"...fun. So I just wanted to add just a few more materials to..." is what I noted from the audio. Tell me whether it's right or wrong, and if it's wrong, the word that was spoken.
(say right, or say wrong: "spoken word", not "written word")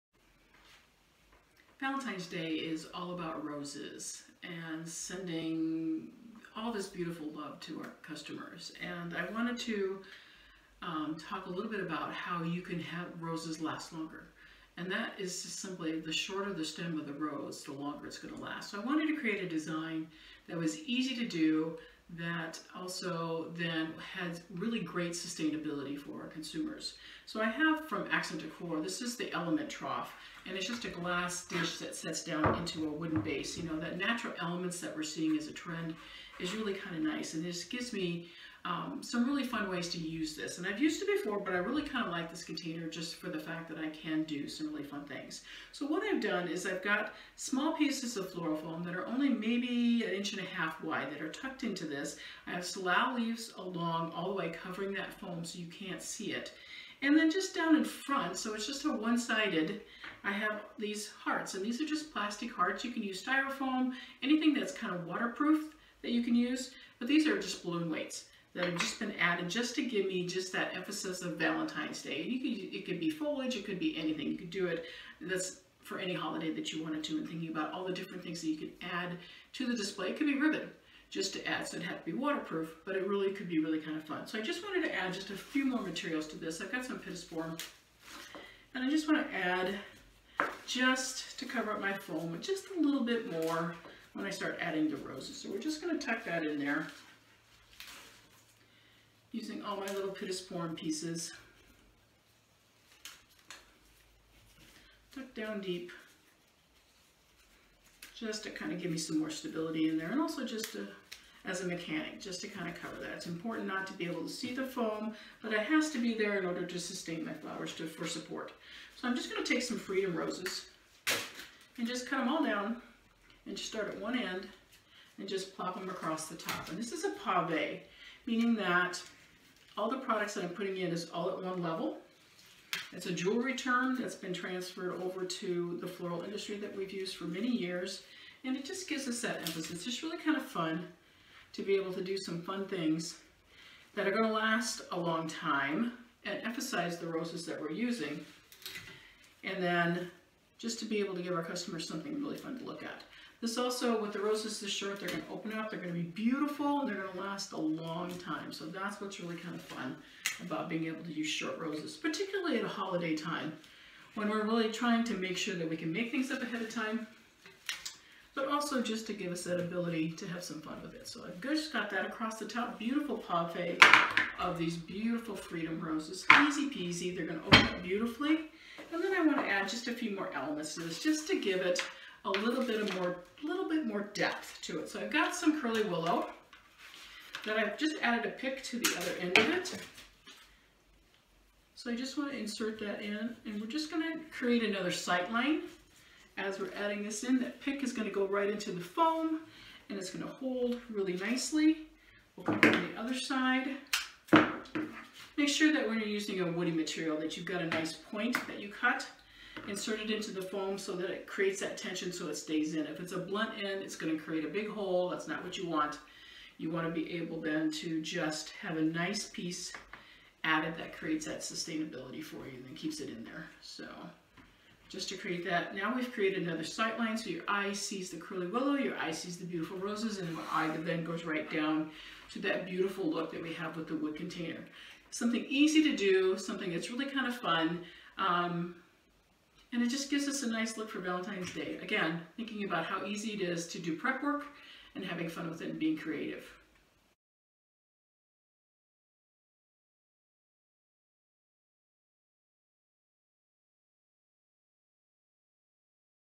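right.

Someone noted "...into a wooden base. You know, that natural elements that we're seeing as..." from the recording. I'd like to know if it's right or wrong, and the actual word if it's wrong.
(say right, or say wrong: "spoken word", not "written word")
right.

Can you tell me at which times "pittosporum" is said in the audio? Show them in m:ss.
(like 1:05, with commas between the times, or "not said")
1:26, 1:40.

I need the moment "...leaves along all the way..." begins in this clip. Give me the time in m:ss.
0:53.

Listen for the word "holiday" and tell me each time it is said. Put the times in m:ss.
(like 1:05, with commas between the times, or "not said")
1:16, 2:42.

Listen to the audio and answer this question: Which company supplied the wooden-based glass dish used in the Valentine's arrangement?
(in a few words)
Accent Decor.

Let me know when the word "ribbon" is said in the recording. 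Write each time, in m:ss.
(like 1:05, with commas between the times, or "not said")
1:20.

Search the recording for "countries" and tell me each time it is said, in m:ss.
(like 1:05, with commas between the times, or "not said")
not said.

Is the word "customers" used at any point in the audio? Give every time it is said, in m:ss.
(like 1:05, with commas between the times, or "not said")
0:08, 2:31.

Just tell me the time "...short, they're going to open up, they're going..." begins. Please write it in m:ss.
2:34.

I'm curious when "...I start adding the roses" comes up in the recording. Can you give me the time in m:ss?
1:34.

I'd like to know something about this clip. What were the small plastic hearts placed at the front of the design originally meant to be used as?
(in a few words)
Balloon weights.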